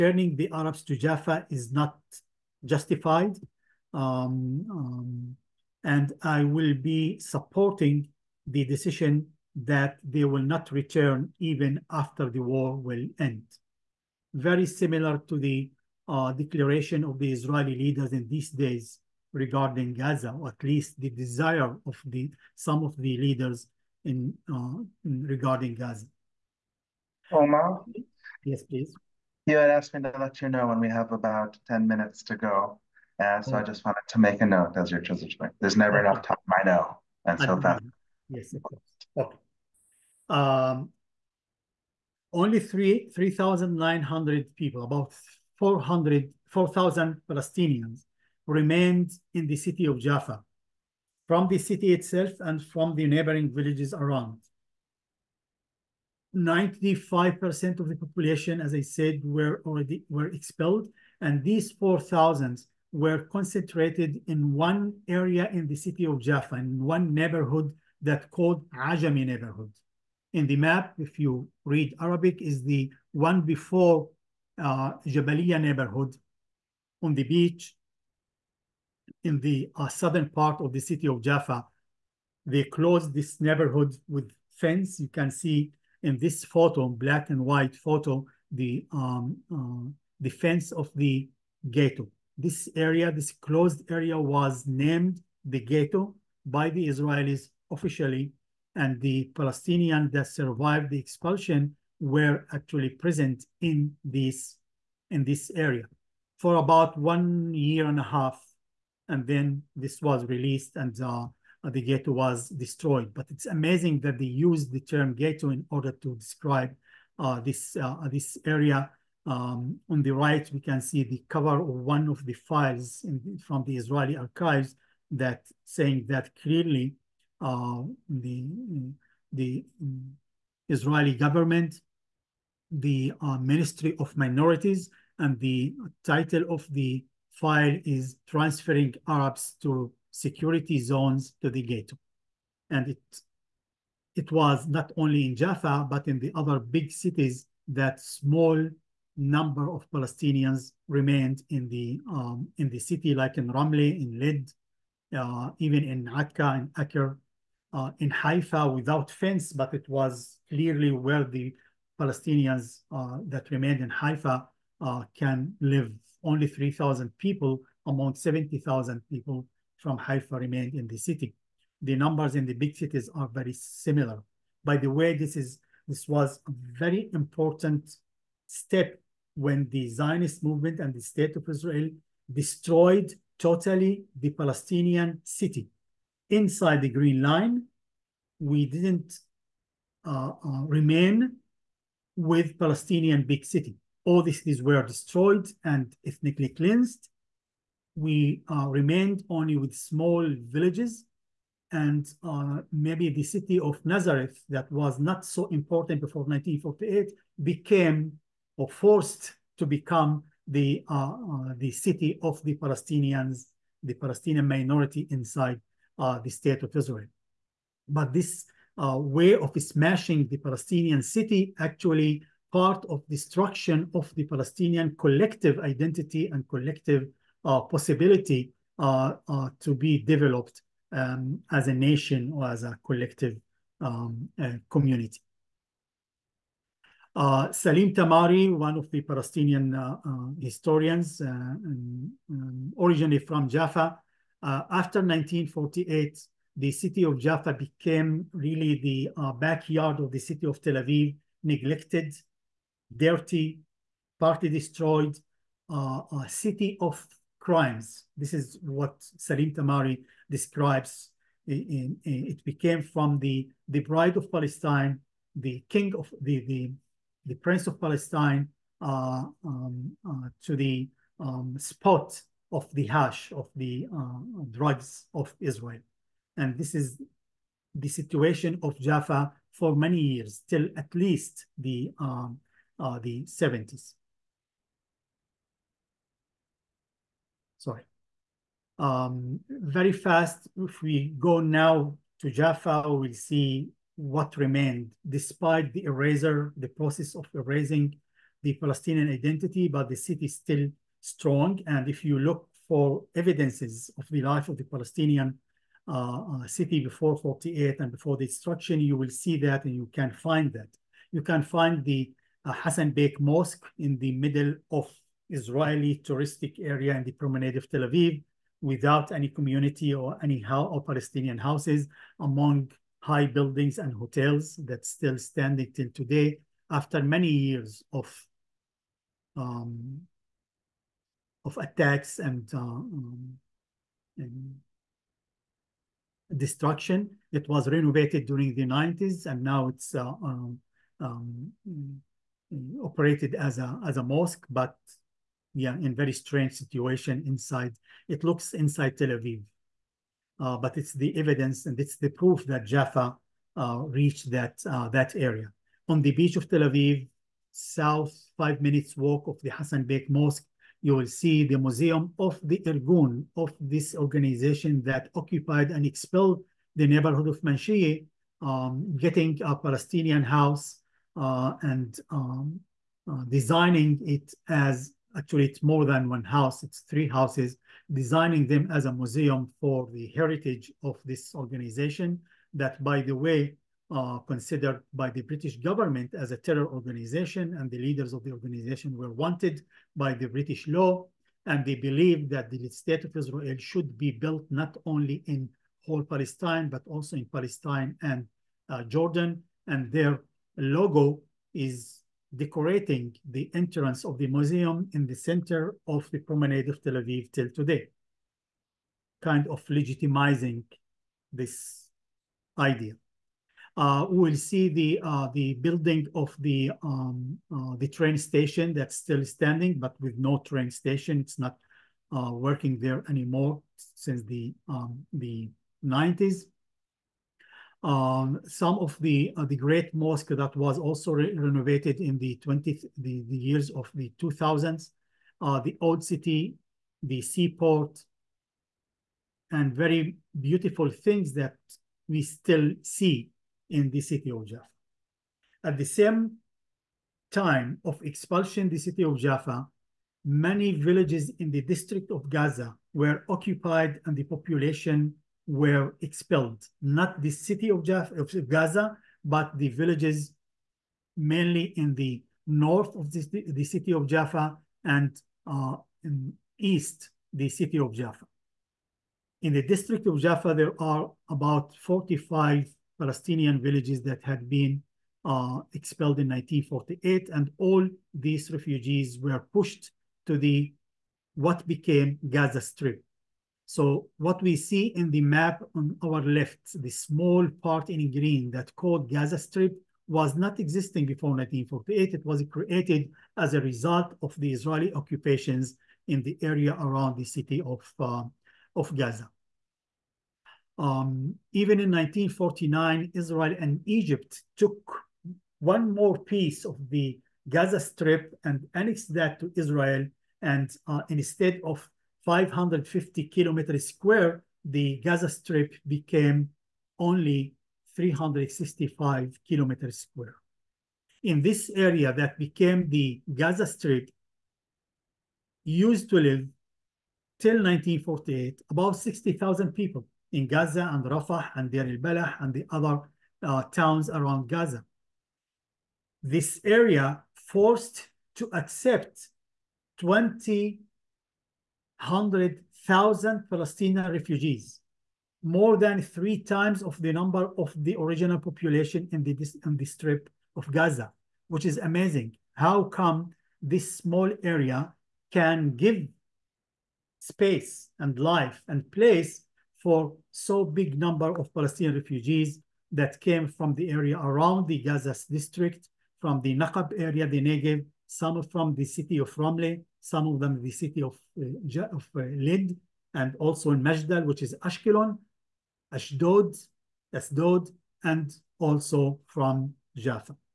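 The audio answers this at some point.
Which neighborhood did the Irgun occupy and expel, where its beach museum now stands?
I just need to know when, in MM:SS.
06:07.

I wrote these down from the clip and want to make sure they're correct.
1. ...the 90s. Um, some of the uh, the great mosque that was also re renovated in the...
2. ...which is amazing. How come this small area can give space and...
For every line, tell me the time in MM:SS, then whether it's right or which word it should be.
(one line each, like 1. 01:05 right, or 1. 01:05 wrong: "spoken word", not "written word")
1. 07:05 right
2. 09:11 right.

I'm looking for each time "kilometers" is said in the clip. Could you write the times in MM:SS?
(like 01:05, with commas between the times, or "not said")
08:33, 08:39.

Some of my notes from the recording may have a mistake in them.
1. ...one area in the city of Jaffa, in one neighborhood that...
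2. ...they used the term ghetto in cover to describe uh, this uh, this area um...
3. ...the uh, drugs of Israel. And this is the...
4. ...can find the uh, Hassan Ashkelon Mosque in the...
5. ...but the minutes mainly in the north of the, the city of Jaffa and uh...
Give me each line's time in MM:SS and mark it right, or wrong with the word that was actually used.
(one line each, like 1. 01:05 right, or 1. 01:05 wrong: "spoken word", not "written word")
1. 01:04 right
2. 01:54 wrong: "order", not "cover"
3. 04:33 right
4. 05:11 wrong: "Bek", not "Ashkelon"
5. 07:39 wrong: "villages", not "minutes".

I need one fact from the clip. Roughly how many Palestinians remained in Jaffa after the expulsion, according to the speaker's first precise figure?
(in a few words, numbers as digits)
3,900.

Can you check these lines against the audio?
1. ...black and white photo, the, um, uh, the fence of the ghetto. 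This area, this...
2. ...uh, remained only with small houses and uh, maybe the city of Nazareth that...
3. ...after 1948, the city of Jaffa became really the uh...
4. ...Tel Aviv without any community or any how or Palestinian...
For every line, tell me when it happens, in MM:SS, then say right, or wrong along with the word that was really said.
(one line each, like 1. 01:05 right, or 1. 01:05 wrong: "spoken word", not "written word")
1. 01:26 right
2. 03:18 wrong: "villages", not "houses"
3. 04:04 right
4. 05:17 right.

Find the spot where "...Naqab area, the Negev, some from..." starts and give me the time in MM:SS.
09:26.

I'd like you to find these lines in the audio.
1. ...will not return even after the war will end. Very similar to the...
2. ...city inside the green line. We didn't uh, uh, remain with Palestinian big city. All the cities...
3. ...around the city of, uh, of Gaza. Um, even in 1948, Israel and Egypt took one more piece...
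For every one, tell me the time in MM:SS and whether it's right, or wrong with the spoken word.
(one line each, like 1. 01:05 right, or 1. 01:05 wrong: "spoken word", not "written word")
1. 00:10 right
2. 03:05 right
3. 08:16 wrong: "1949", not "1948".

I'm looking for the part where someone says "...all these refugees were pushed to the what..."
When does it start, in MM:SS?
07:57.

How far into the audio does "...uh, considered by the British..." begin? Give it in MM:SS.
06:23.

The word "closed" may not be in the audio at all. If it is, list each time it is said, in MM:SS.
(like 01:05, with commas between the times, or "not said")
01:22, 01:33.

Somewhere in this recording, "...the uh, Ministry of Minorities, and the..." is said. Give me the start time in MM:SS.
02:12.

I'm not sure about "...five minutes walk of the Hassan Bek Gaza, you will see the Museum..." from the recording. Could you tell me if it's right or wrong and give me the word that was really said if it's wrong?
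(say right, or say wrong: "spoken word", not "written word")
wrong: "Mosque", not "Gaza".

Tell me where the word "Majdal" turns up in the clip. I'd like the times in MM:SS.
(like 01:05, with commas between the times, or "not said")
09:33.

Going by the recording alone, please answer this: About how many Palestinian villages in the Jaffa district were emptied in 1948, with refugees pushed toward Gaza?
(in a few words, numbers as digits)
45.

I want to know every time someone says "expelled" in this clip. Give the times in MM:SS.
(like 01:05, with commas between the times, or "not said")
01:00, 06:05, 07:36, 07:55.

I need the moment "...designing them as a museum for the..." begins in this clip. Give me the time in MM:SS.
06:17.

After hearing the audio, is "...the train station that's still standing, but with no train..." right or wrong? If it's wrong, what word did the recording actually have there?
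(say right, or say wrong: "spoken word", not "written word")
right.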